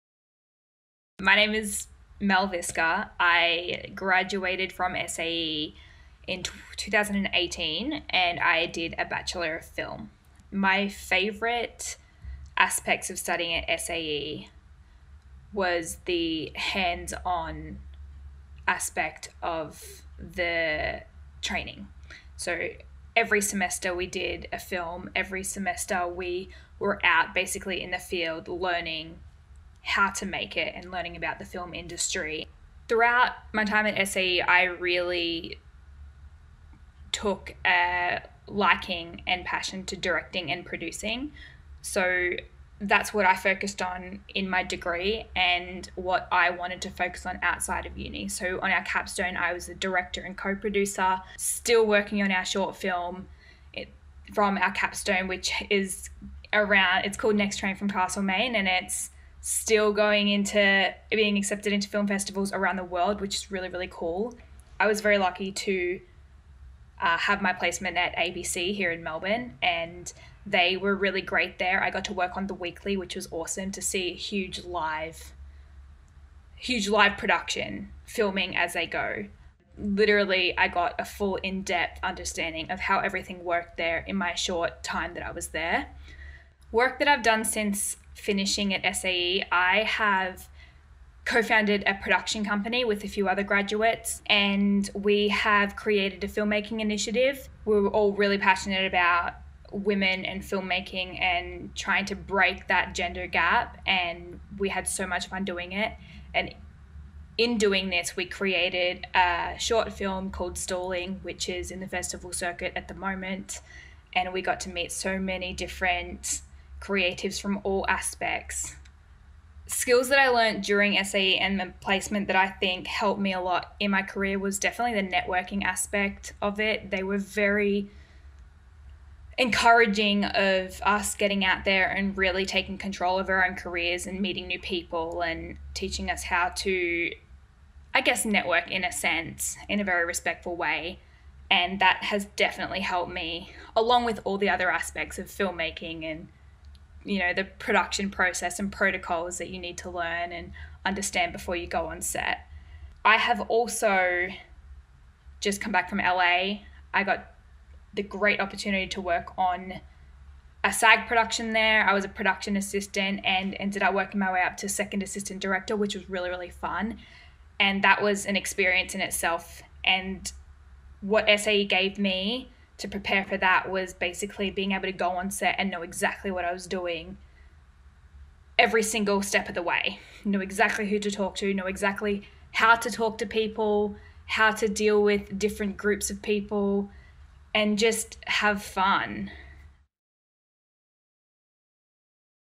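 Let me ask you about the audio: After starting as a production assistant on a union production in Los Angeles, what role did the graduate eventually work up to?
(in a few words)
Second assistant director.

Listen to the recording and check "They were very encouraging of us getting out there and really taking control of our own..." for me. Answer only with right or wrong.
right.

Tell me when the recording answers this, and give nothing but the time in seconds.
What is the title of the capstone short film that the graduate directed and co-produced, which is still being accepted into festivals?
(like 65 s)
57 s.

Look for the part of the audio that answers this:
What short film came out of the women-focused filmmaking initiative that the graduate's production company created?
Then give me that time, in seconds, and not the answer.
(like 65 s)
110 s.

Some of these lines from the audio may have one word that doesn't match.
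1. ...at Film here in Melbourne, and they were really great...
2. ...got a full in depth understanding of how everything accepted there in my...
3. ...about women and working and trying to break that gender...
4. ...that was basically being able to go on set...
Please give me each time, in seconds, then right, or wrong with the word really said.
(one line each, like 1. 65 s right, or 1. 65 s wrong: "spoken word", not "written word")
1. 67 s wrong: "ABC", not "Film"
2. 80 s wrong: "worked", not "accepted"
3. 98 s wrong: "filmmaking", not "working"
4. 173 s right.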